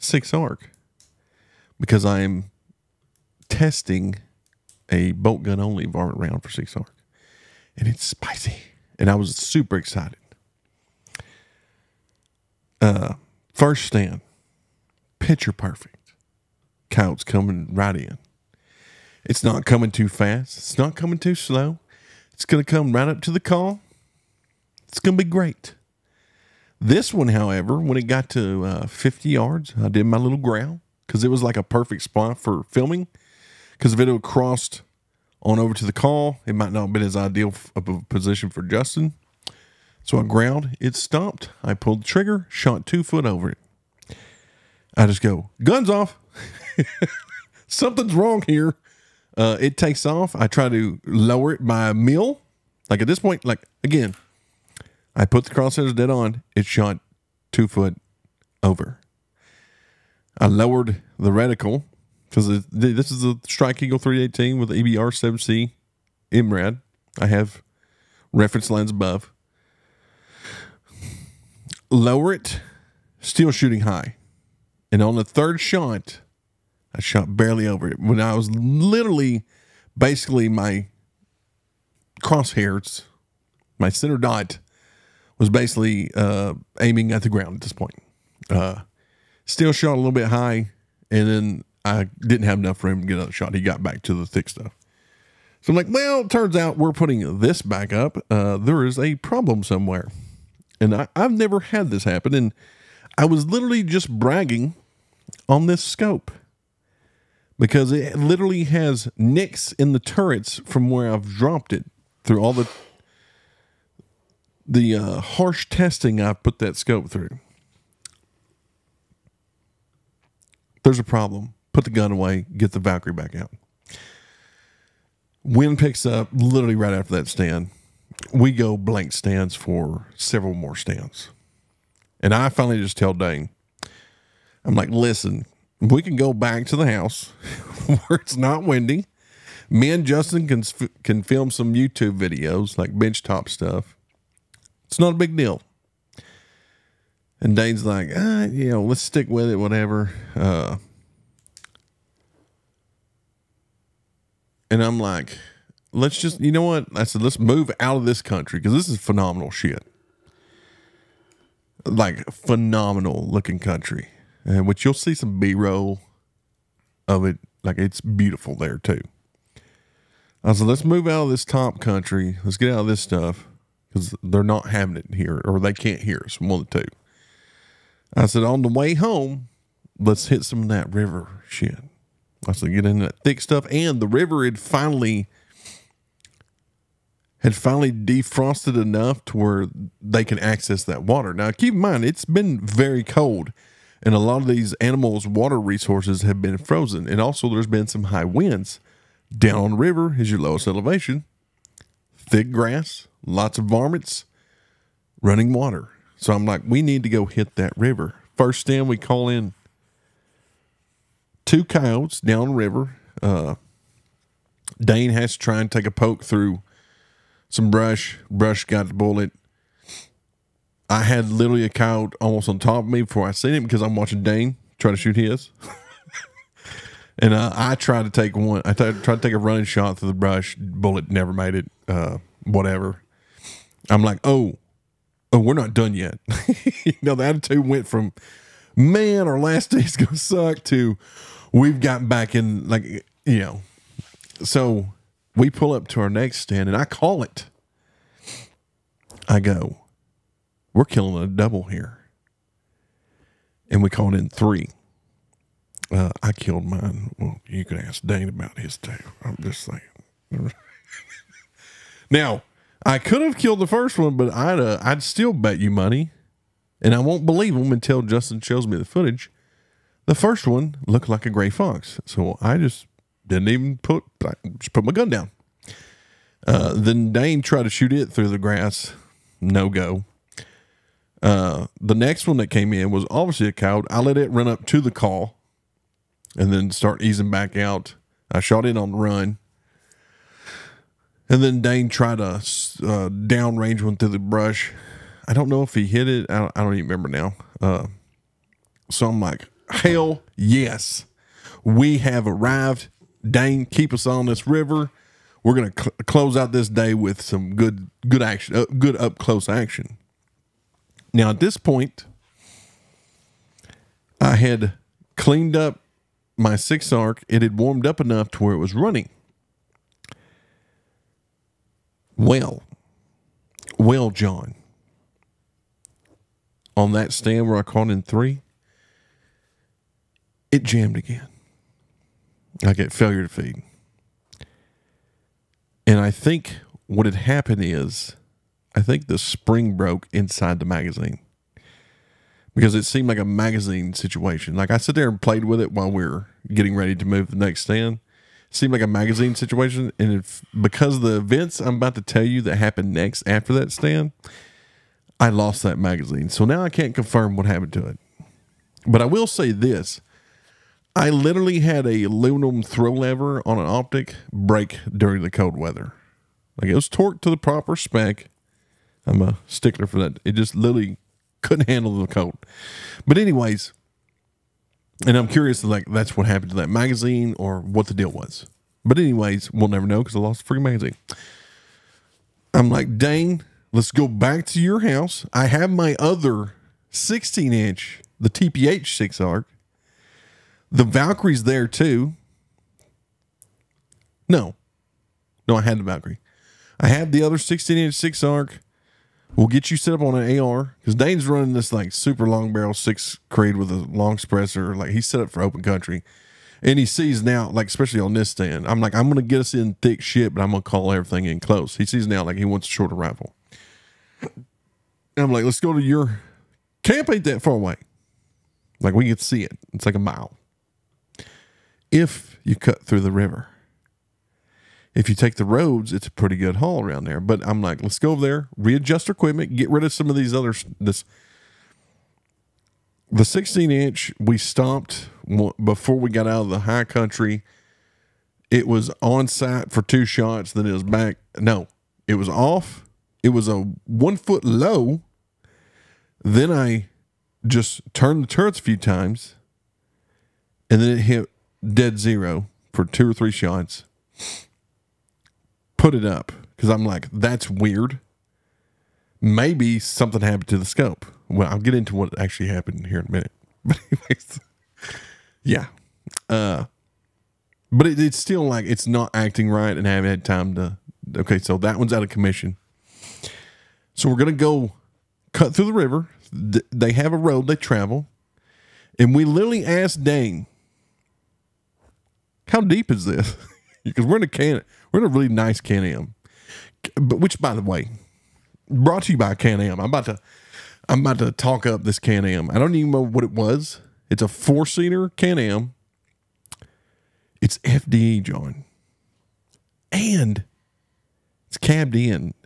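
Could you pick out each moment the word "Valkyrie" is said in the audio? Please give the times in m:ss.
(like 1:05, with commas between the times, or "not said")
2:02, 6:30, 6:35.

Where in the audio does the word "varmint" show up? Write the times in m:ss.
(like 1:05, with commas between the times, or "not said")
0:05, 3:23.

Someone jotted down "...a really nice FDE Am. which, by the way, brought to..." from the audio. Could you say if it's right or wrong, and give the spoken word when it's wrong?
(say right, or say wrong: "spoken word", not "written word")
wrong: "Can", not "FDE".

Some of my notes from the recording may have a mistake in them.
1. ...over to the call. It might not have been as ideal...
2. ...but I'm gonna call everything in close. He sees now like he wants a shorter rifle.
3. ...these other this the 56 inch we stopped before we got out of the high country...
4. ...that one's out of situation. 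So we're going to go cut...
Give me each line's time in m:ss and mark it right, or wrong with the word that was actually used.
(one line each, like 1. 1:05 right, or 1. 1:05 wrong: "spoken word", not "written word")
1. 0:35 right
2. 6:50 right
3. 7:10 wrong: "16", not "56"
4. 7:51 wrong: "commission", not "situation".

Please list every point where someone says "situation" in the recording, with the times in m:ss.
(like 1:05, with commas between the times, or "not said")
5:43, 5:49.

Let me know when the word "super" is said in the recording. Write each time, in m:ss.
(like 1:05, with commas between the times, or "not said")
0:09, 6:41.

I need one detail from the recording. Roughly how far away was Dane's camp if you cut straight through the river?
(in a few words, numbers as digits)
1 mile.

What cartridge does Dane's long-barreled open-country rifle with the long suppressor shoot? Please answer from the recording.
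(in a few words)
6 Creedmoor.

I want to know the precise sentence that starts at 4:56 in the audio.
I don't, I don't even remember now.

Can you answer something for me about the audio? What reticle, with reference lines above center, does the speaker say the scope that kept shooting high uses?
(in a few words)
EBR 7C MRAD.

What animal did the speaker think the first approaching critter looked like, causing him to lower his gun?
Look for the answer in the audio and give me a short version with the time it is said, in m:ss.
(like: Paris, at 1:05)
gray fox, at 4:31.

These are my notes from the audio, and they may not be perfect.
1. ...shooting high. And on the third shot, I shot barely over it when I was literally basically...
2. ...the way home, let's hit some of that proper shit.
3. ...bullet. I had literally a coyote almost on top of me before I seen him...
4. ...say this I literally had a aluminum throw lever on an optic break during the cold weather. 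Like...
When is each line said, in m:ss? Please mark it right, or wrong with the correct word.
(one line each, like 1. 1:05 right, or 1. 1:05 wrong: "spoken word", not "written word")
1. 1:13 right
2. 2:58 wrong: "river", not "proper"
3. 3:38 right
4. 5:59 right.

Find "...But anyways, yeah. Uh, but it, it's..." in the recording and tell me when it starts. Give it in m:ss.
7:43.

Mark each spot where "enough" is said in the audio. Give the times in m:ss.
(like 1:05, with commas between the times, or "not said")
1:32, 3:08, 5:17.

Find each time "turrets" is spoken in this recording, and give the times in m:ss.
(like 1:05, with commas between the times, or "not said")
1:49, 7:28.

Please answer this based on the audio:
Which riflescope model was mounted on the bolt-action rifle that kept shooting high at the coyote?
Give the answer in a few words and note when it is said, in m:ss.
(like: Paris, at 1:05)
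Strike Eagle 318, at 1:03.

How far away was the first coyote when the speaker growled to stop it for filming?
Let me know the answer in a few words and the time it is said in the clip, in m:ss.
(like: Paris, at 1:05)
50 yards, at 0:28.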